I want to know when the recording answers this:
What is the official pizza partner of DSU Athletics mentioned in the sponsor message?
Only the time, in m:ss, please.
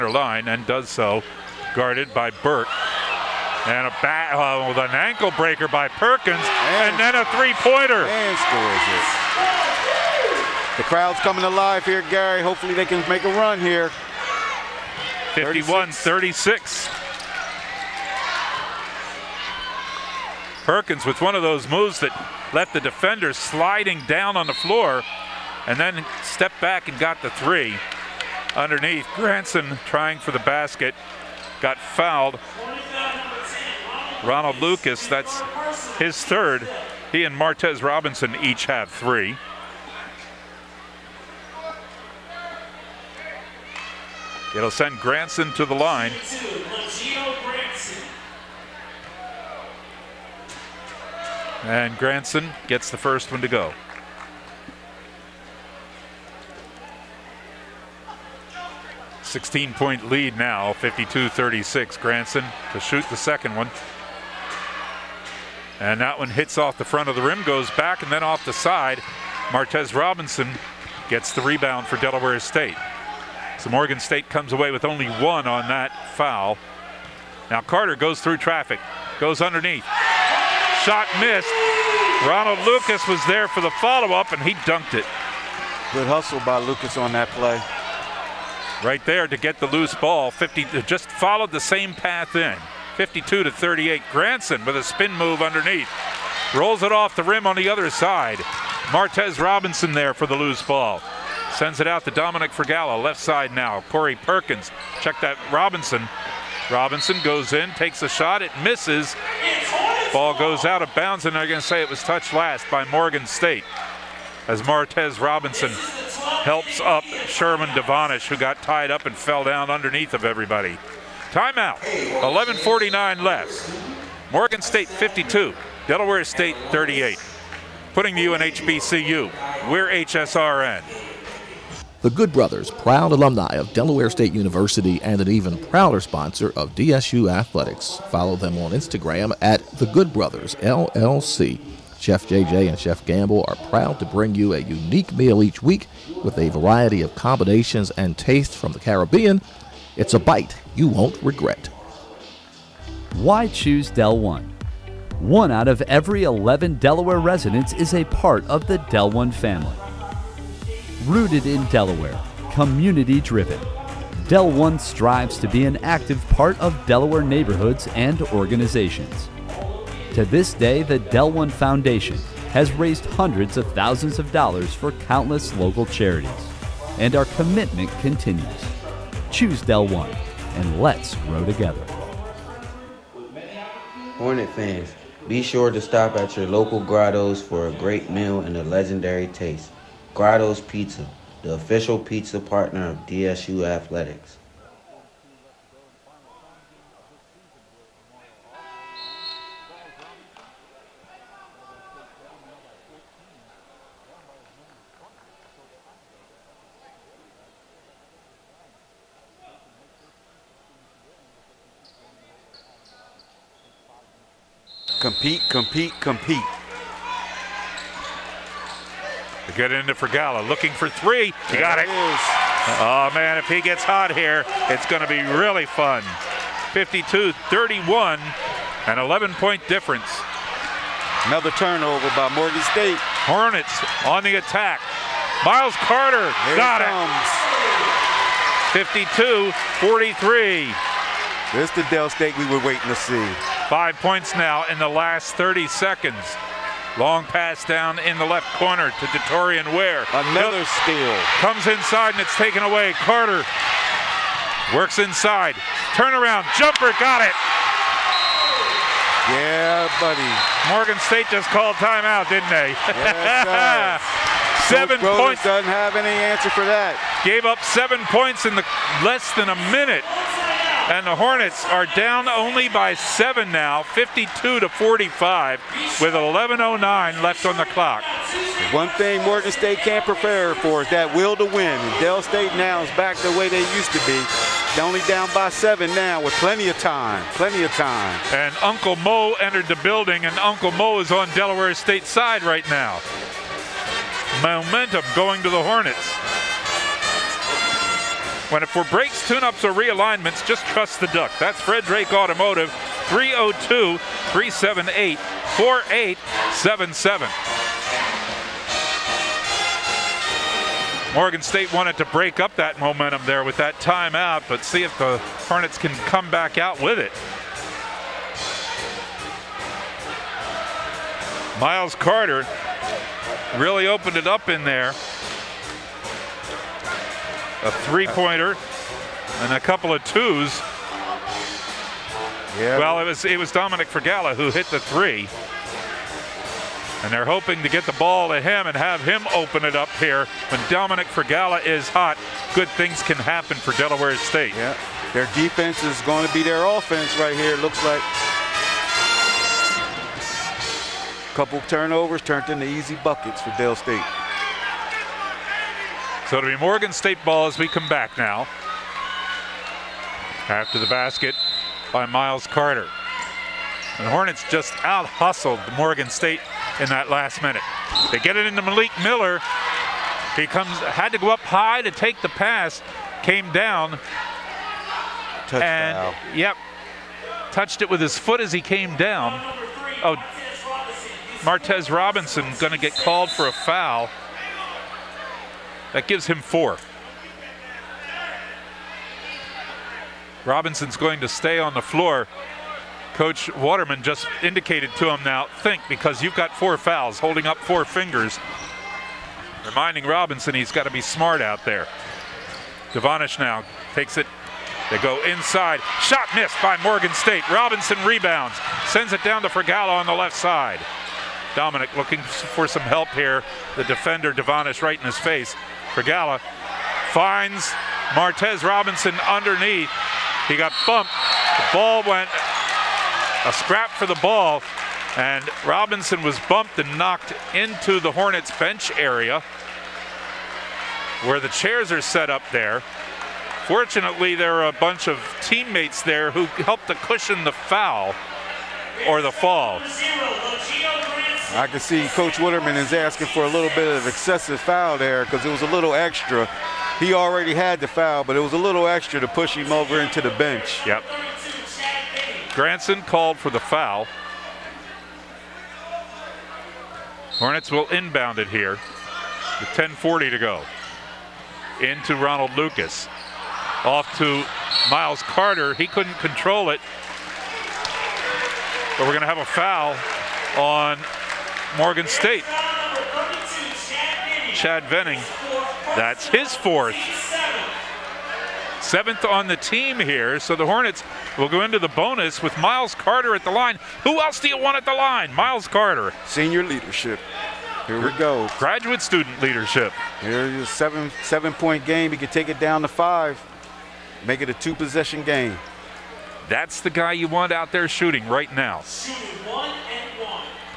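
3:10.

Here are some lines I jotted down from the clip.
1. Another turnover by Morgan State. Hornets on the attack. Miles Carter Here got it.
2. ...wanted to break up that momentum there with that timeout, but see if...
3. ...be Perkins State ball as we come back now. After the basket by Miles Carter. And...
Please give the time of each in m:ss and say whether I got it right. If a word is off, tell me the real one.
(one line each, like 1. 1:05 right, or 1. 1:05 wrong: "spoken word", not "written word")
1. 3:51 right
2. 5:11 right
3. 5:56 wrong: "Morgan", not "Perkins".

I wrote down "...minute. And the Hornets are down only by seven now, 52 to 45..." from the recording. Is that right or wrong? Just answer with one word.
right.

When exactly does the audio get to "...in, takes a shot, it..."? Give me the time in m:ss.
1:47.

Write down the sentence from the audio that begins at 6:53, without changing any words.
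The defender, Devonish, right in his face.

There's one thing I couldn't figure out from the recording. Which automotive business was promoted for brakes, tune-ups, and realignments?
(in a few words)
Fred Drake Automotive.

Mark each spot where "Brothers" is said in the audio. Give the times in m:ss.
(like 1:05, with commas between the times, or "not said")
2:12, 2:20.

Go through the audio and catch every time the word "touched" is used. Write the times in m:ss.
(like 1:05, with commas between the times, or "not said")
1:52, 6:17.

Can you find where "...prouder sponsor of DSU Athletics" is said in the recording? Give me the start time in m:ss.
2:15.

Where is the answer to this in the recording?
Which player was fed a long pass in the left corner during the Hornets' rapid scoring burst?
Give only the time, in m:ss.
4:09.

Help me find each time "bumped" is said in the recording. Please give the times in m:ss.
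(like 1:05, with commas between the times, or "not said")
7:00, 7:06.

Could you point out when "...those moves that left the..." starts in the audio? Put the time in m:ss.
0:21.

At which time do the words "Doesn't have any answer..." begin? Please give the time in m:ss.
4:25.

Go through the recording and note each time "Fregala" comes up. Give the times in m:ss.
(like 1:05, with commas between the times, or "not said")
1:42, 6:49.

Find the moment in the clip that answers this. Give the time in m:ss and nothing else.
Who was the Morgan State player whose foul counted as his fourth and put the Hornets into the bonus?
7:54.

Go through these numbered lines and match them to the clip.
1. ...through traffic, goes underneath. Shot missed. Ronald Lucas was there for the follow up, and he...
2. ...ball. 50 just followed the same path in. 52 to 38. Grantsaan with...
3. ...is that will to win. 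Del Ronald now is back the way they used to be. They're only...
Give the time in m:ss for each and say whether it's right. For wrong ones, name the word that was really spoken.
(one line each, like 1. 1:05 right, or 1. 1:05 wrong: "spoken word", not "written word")
1. 1:18 right
2. 1:29 right
3. 4:40 wrong: "State", not "Ronald".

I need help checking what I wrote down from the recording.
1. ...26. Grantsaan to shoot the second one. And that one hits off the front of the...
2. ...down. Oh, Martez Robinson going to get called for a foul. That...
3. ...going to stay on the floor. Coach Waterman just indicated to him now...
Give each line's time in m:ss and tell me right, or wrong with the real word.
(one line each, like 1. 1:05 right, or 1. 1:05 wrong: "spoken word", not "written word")
1. 1:01 wrong: "36", not "26"
2. 6:18 right
3. 6:30 right.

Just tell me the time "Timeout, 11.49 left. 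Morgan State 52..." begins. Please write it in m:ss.
2:01.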